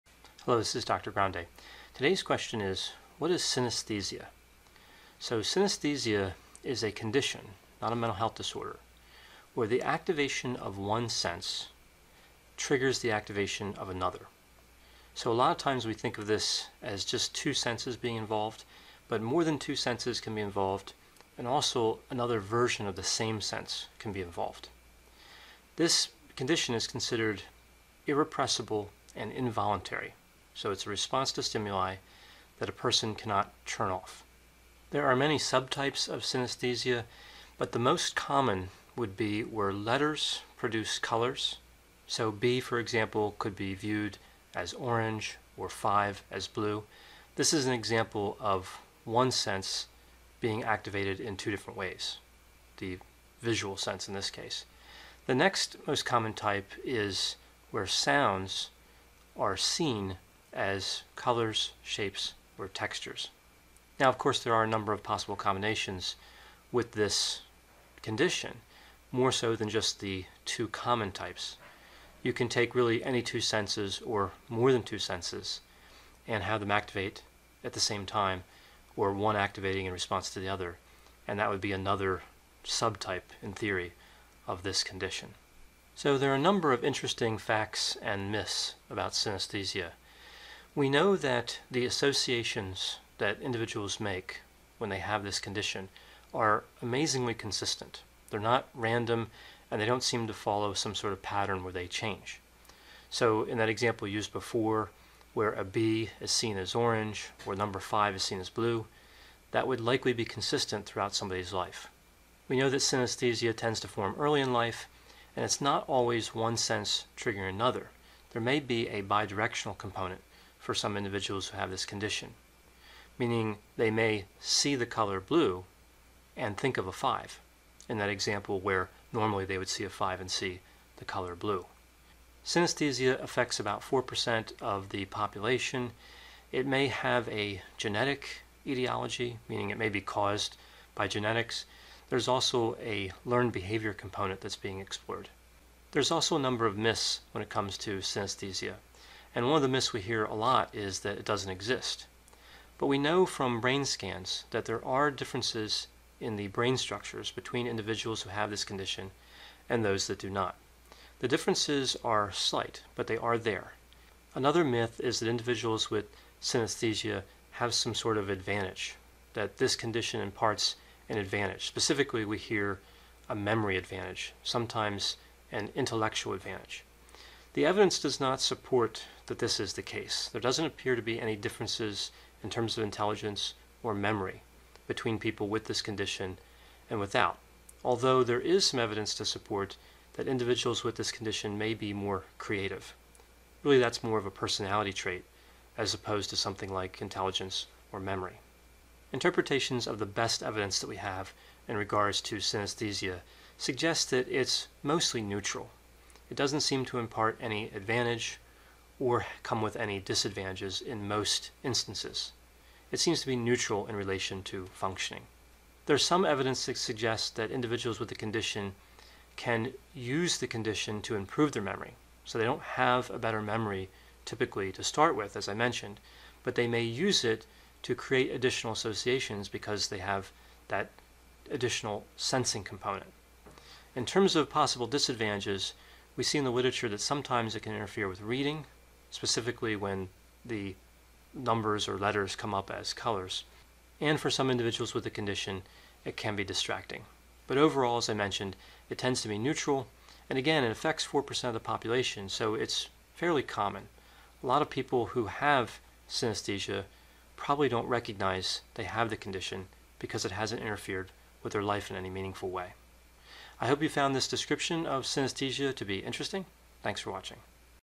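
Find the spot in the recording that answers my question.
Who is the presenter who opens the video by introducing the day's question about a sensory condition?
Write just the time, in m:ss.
0:00.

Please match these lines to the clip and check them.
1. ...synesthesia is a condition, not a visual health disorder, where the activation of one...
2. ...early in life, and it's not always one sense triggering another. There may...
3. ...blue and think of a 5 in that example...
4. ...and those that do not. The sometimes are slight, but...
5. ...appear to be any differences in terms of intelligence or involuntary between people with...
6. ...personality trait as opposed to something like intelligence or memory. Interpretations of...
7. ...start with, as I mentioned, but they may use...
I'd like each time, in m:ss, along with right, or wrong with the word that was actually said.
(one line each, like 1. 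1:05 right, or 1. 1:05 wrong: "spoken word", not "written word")
1. 0:05 wrong: "mental", not "visual"
2. 1:54 right
3. 2:05 right
4. 2:39 wrong: "differences", not "sometimes"
5. 3:00 wrong: "memory", not "involuntary"
6. 3:14 right
7. 3:44 right.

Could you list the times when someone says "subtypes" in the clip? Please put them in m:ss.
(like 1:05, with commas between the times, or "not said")
0:35, 1:22.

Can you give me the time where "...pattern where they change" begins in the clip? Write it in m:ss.
1:41.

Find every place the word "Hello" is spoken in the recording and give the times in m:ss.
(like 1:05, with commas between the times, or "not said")
0:00.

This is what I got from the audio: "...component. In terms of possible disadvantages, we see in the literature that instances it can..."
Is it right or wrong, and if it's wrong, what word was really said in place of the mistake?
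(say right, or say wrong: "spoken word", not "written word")
wrong: "sometimes", not "instances".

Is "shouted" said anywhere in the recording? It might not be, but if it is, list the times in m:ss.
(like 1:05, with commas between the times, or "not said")
not said.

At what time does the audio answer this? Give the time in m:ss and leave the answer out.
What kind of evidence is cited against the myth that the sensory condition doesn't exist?
2:33.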